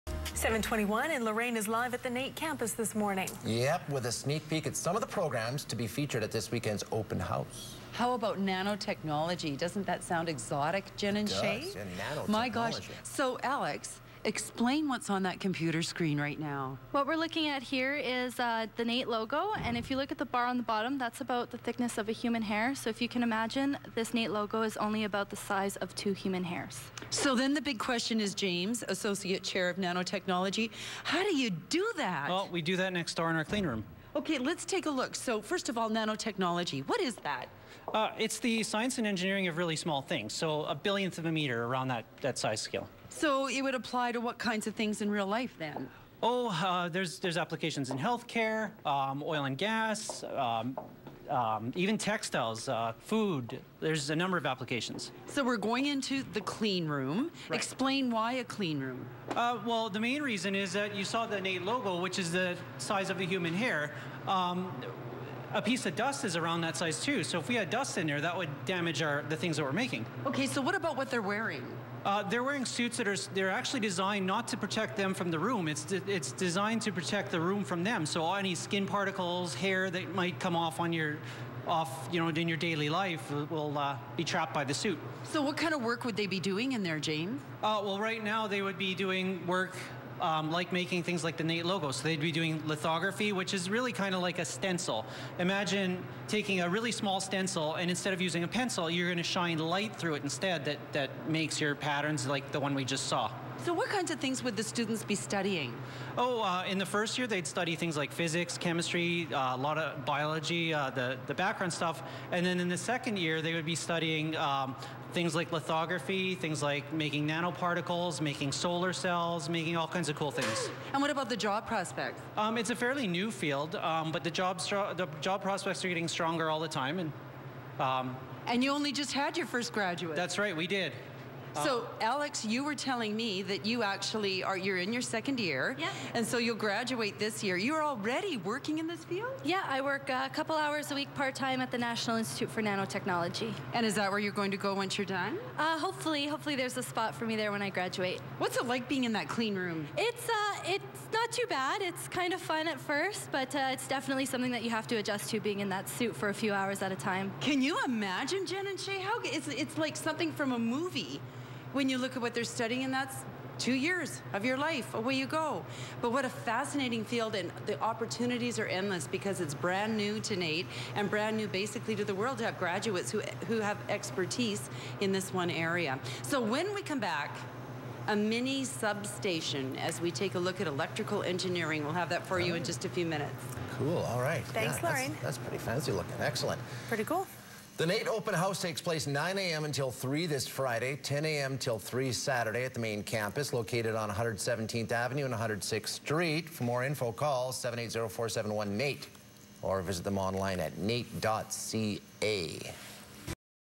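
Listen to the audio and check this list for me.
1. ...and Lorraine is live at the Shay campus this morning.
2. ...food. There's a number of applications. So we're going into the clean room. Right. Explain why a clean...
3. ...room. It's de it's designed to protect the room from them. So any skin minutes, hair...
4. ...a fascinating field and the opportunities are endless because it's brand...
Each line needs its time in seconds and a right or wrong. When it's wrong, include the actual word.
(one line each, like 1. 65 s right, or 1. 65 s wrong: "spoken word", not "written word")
1. 1 s wrong: "NAIT", not "Shay"
2. 52 s right
3. 75 s wrong: "particles", not "minutes"
4. 166 s right.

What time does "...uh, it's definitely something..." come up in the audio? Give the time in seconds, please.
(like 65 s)
153 s.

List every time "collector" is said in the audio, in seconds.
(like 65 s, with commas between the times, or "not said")
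not said.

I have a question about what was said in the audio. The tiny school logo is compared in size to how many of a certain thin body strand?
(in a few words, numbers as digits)
2 human hairs.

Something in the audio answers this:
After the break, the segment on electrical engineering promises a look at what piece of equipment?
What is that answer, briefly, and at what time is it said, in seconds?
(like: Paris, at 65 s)
A mini substation, at 178 s.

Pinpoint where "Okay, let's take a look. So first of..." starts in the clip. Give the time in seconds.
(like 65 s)
34 s.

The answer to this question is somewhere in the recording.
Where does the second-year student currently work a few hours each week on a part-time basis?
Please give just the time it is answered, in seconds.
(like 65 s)
141 s.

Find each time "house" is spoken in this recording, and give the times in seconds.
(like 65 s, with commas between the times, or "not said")
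7 s, 188 s.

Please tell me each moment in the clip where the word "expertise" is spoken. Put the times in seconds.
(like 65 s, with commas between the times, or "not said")
173 s.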